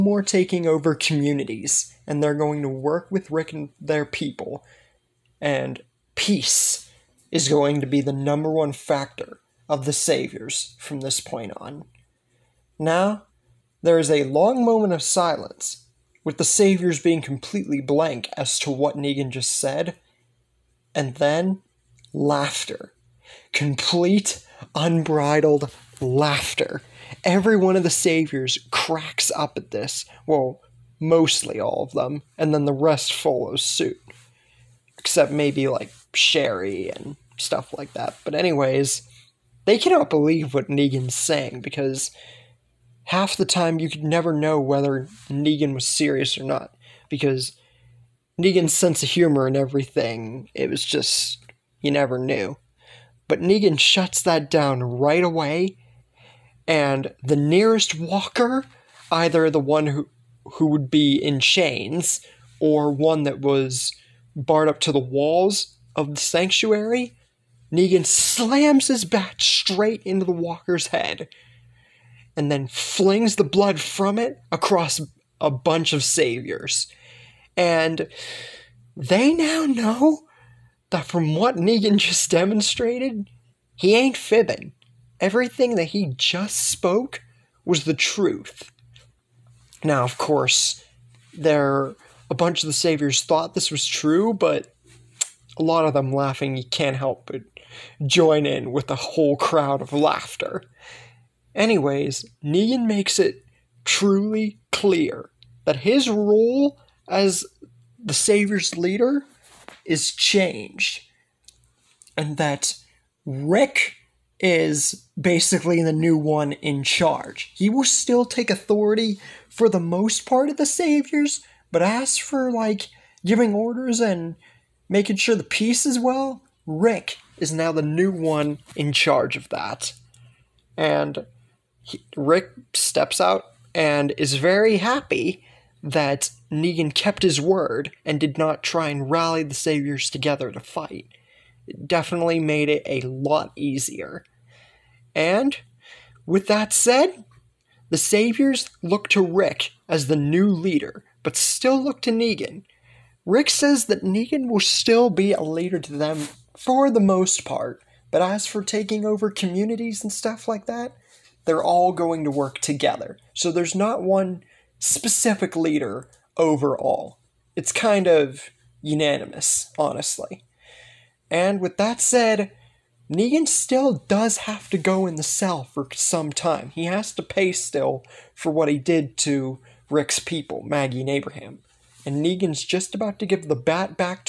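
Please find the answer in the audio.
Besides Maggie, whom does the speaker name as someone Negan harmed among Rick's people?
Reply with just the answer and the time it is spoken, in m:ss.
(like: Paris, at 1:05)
Abraham, at 3:01.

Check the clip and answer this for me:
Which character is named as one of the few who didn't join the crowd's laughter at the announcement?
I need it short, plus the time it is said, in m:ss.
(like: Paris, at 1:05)
Sherry, at 0:36.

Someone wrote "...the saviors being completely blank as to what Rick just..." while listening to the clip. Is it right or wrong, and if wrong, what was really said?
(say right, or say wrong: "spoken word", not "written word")
wrong: "Negan", not "Rick".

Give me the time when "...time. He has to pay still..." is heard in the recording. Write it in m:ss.
2:56.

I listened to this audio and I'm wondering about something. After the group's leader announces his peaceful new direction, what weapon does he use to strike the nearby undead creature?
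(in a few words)
His bat.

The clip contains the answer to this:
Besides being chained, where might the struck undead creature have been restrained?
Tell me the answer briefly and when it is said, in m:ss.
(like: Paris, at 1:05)
Walls of the sanctuary, at 1:04.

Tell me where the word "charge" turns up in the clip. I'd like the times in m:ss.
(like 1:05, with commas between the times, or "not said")
1:56, 2:08.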